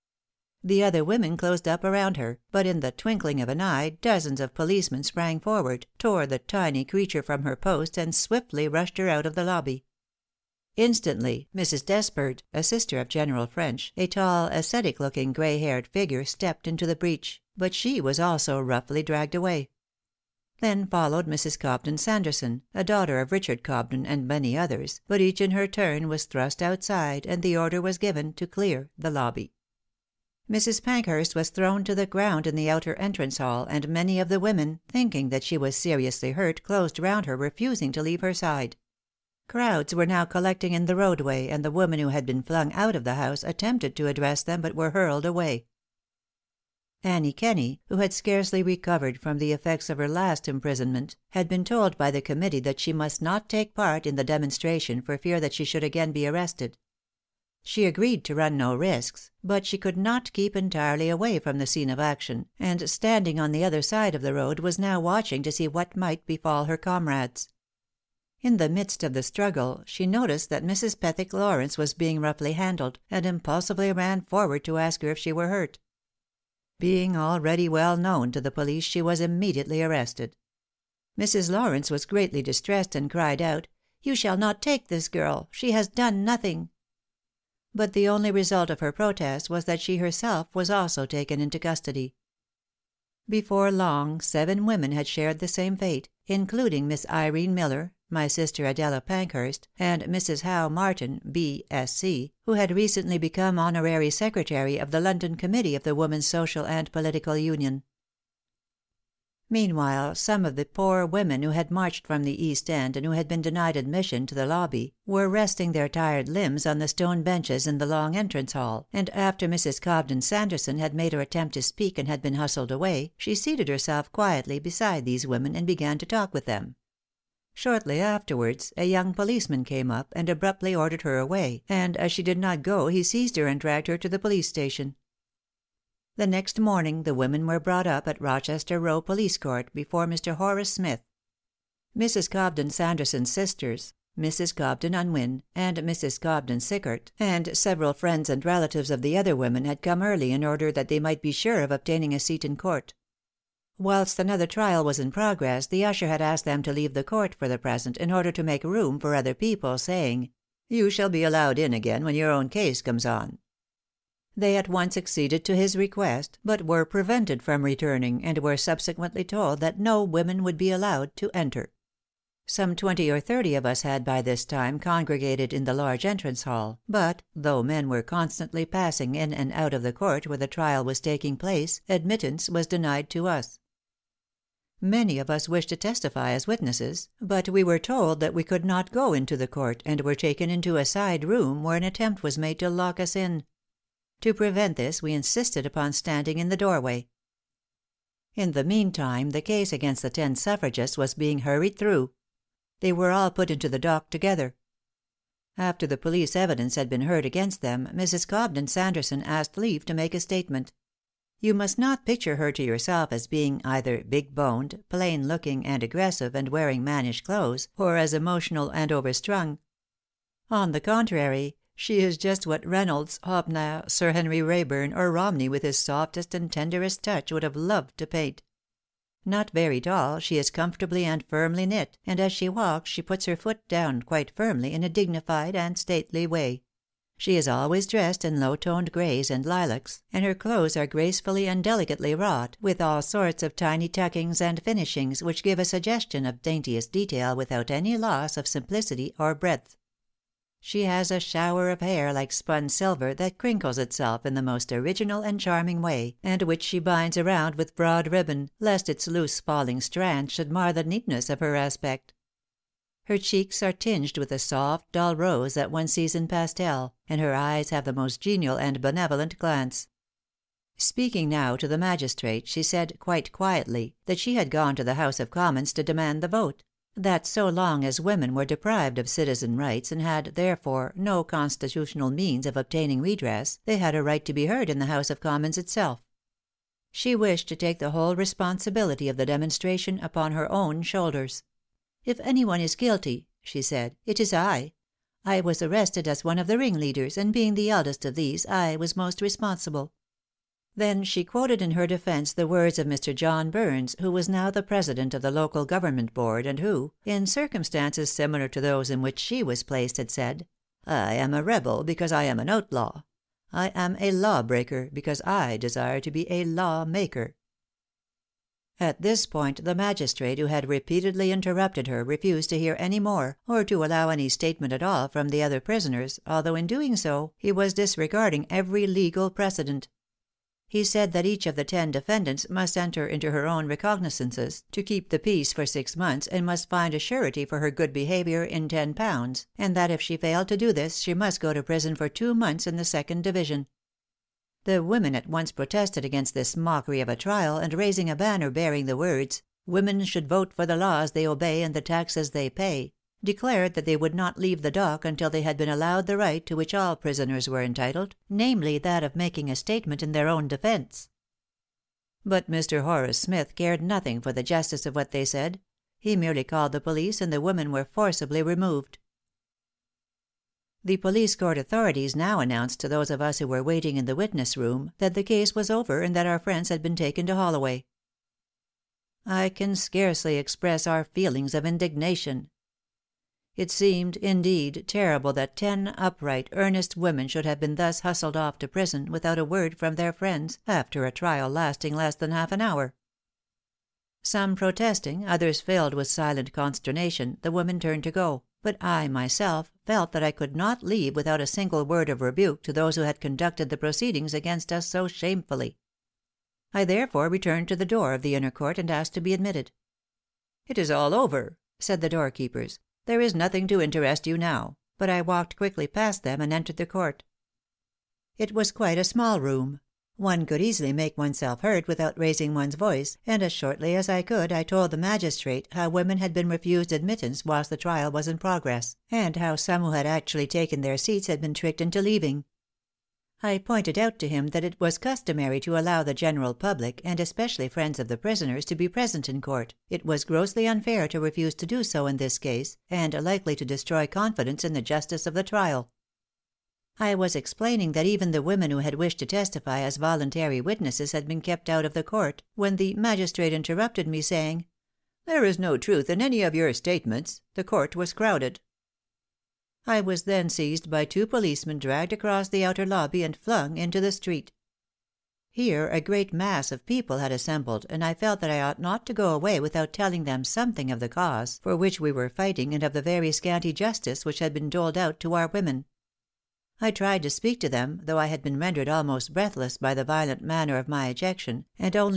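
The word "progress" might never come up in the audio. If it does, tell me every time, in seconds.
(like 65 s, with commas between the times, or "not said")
155 s, 428 s.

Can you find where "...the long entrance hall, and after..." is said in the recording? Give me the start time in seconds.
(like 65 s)
117 s.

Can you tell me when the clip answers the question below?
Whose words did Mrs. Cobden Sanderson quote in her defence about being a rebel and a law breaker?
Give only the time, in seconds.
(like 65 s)
303 s.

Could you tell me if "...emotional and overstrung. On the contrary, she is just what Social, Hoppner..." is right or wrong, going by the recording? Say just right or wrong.
wrong.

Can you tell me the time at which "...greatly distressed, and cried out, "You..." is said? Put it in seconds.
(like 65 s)
82 s.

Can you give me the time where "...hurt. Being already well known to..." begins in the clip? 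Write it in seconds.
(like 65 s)
75 s.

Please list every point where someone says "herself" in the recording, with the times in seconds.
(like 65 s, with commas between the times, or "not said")
89 s, 123 s.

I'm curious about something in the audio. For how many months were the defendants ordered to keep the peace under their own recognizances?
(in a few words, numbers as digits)
6 months.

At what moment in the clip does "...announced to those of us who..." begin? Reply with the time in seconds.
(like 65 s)
372 s.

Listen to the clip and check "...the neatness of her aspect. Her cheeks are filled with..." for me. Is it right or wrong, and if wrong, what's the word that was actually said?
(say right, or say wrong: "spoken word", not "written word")
wrong: "tinged", not "filled".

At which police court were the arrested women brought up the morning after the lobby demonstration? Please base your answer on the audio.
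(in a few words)
Rochester Row.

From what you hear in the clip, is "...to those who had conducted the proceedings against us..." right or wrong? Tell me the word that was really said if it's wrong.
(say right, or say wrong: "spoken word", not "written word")
right.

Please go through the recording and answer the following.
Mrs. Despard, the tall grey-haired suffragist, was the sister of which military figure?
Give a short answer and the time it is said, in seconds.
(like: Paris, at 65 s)
General French, at 13 s.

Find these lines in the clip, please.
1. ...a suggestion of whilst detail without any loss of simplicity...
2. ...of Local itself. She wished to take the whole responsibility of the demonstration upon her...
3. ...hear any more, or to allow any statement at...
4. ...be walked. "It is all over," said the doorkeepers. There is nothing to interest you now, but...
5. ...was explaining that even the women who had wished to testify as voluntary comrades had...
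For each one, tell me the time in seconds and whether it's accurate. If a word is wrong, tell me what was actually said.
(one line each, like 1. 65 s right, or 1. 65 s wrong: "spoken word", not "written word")
1. 245 s wrong: "daintiest", not "whilst"
2. 285 s wrong: "Commons", not "Local"
3. 322 s right
4. 409 s wrong: "admitted", not "walked"
5. 447 s wrong: "witnesses", not "comrades".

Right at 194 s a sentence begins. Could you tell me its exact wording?
To prevent this we insisted upon standing in the doorway.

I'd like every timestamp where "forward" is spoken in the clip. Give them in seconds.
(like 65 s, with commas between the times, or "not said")
5 s, 74 s.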